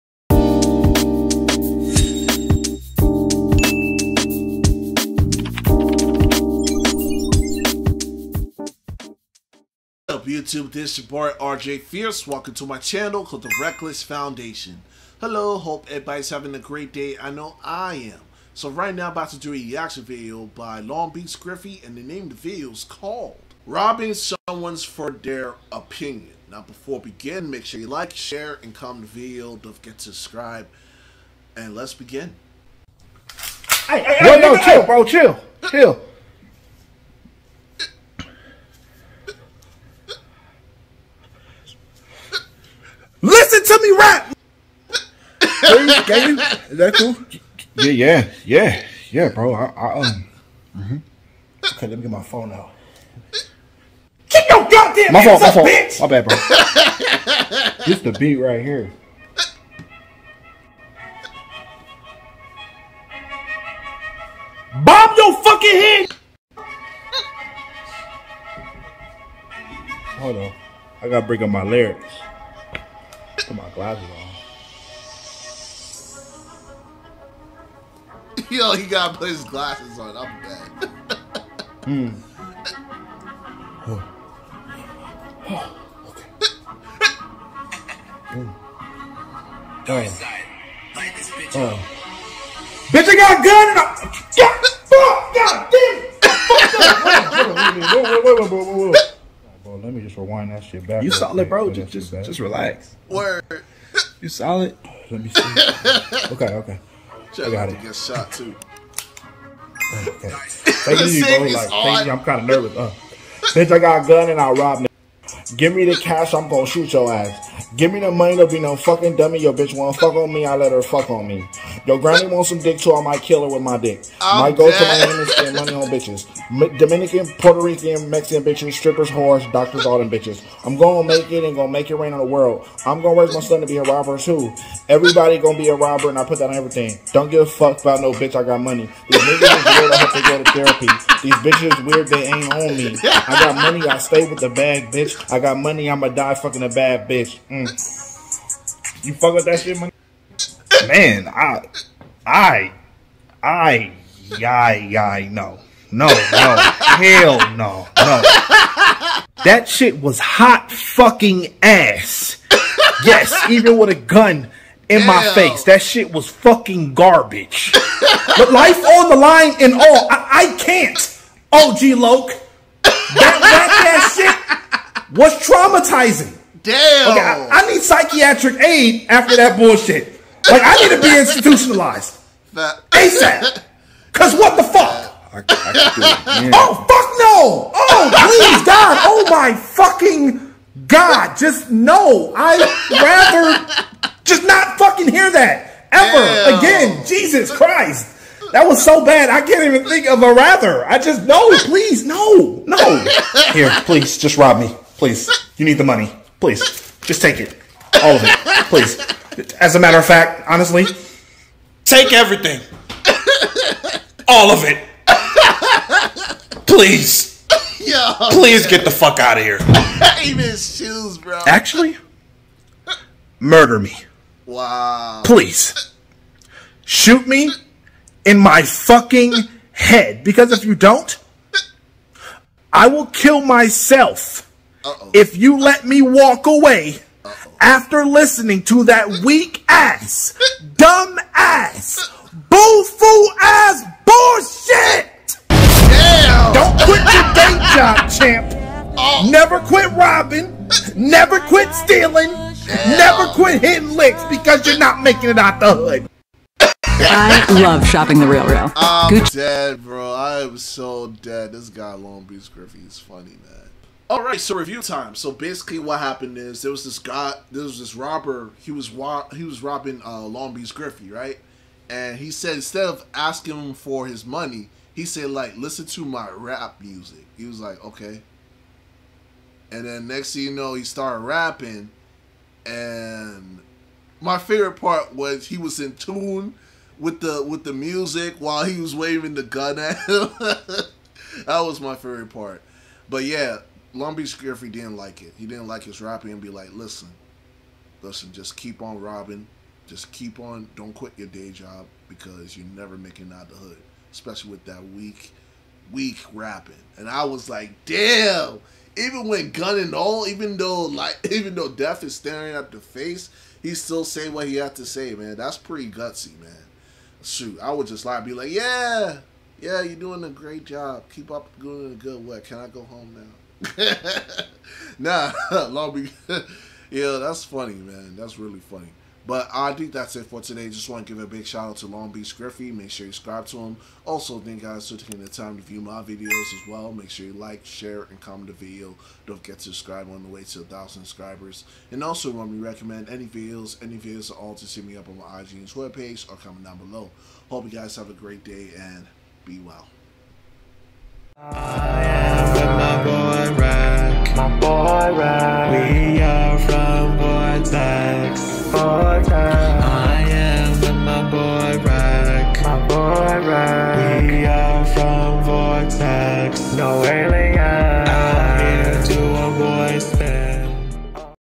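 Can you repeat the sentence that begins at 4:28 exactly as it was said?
He was he was robbing uh, Long Beach Griffy, right?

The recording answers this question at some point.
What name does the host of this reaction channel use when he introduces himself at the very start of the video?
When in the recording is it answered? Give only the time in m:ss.
0:11.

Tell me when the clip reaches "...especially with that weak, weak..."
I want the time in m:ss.
5:04.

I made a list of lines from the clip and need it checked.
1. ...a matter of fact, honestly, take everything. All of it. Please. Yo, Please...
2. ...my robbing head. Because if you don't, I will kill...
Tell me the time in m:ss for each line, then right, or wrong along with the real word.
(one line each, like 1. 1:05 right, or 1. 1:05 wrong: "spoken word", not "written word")
1. 3:29 right
2. 3:48 wrong: "fucking", not "robbing".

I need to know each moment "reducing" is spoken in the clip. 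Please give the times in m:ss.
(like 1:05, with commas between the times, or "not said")
not said.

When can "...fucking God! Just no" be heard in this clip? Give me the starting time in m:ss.
3:09.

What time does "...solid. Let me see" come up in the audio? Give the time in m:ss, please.
1:44.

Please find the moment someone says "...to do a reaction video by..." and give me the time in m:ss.
0:19.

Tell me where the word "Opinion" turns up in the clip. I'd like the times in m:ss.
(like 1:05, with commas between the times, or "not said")
0:25.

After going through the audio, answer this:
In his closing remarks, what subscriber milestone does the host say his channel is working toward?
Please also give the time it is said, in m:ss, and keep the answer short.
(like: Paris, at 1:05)
1000 subscribers, at 5:40.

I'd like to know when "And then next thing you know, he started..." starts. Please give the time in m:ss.
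4:39.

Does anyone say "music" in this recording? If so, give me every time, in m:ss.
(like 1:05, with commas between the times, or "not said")
4:36, 4:47.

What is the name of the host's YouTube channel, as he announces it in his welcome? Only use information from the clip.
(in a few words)
The Reckless Foundation.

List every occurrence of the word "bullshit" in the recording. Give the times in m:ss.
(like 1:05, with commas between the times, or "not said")
2:59, 4:04.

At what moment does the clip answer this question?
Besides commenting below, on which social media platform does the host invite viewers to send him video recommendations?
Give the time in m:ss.
5:45.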